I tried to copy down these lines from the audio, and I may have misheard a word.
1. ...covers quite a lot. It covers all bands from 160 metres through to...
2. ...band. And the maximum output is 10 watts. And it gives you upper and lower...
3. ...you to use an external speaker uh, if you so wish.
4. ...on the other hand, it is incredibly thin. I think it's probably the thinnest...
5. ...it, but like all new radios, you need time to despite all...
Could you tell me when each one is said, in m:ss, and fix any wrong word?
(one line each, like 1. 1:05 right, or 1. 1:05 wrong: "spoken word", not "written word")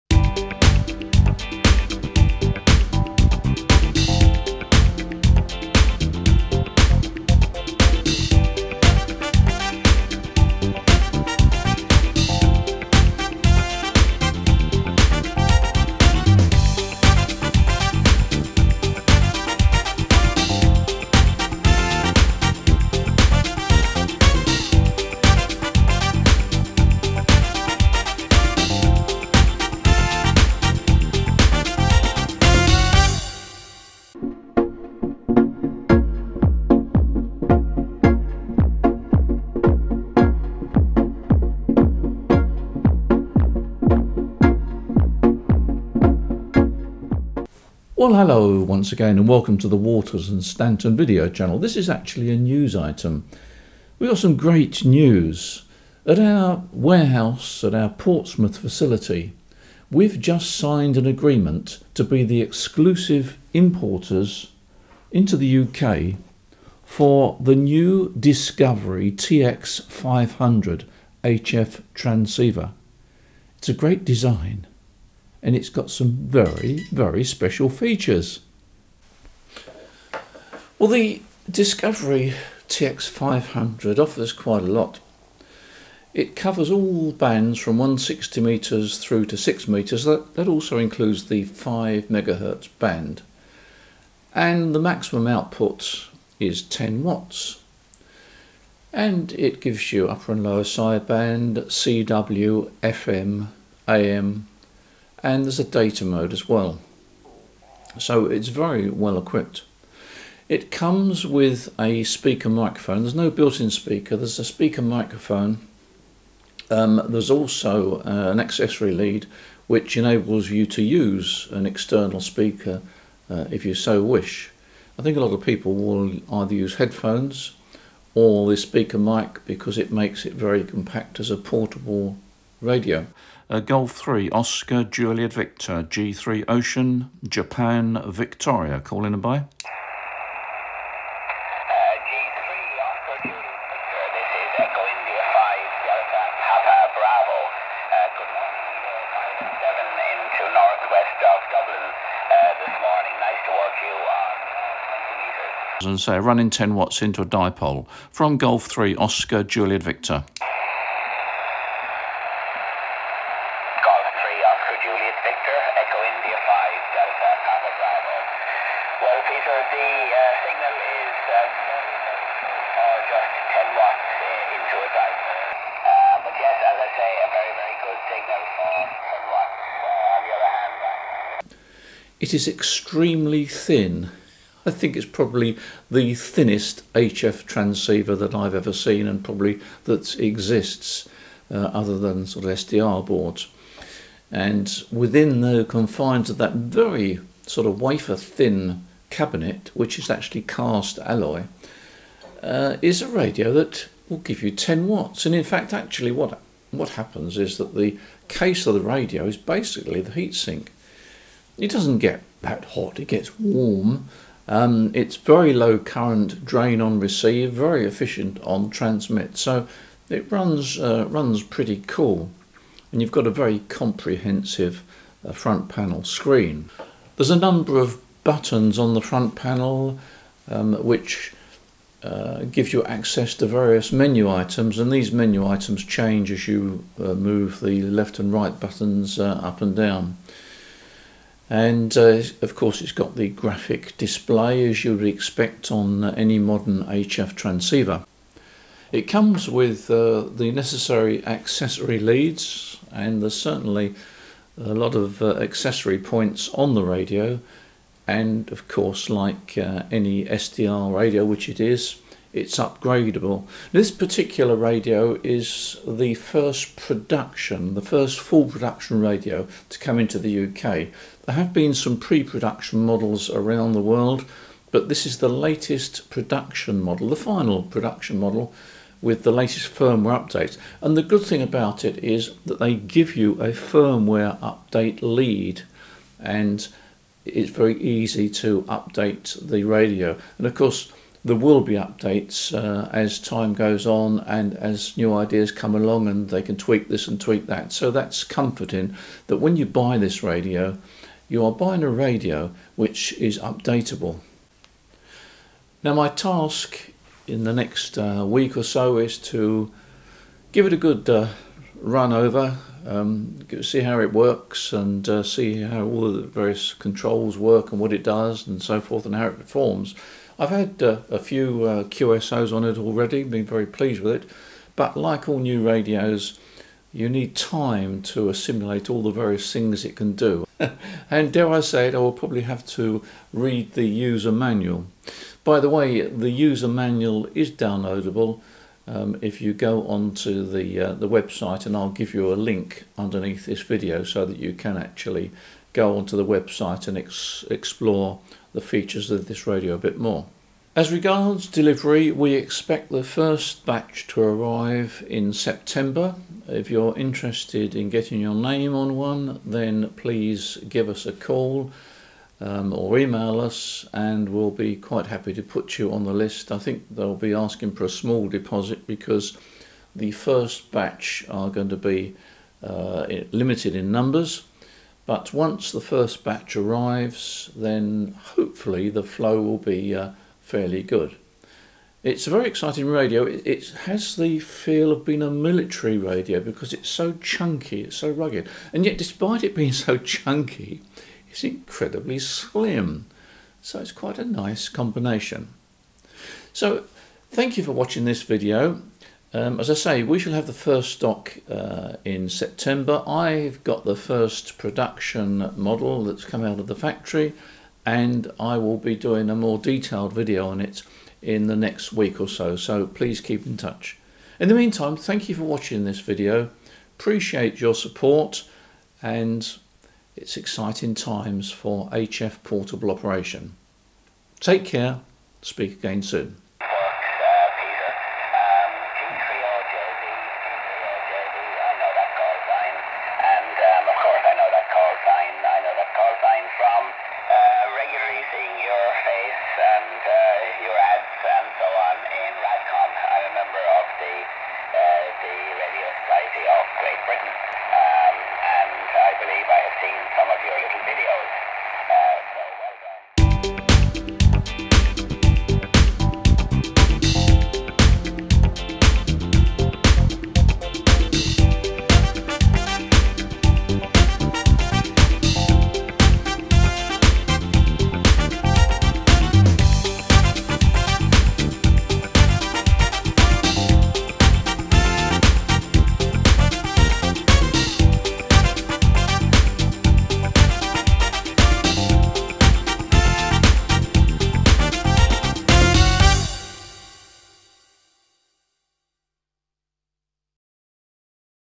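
1. 1:23 wrong: "offers", not "covers"
2. 1:32 right
3. 2:00 right
4. 3:00 wrong: "extremely", not "incredibly"
5. 5:24 wrong: "assimilate", not "despite".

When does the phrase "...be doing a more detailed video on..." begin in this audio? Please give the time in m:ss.
6:48.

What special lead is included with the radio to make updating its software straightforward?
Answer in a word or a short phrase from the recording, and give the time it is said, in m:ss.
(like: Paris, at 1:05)
firmware update lead, at 4:43.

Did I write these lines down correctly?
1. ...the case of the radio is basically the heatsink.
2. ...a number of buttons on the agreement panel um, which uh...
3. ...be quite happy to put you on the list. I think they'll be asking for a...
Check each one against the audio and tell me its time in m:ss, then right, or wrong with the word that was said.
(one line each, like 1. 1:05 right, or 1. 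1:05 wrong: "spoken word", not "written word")
1. 3:27 right
2. 3:47 wrong: "front", not "agreement"
3. 6:04 right.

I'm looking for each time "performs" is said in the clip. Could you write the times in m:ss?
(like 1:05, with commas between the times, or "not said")
5:19.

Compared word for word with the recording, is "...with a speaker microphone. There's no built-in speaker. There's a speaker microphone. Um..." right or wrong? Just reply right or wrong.
right.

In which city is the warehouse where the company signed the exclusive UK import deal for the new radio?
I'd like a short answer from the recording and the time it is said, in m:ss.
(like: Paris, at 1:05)
Portsmouth, at 0:57.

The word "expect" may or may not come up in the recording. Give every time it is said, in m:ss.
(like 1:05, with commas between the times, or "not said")
4:05, 5:52.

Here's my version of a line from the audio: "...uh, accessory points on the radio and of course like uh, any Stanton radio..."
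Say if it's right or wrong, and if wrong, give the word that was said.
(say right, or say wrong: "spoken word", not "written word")
wrong: "SDR", not "Stanton".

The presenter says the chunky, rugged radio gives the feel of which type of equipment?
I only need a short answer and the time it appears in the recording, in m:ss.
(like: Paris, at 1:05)
military radio, at 6:25.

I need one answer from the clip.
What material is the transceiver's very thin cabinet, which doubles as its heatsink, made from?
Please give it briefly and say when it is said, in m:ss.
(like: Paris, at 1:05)
cast alloy, at 3:20.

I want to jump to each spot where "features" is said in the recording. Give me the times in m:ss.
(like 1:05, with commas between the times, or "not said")
1:17, 5:48.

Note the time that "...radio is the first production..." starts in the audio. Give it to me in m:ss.
4:24.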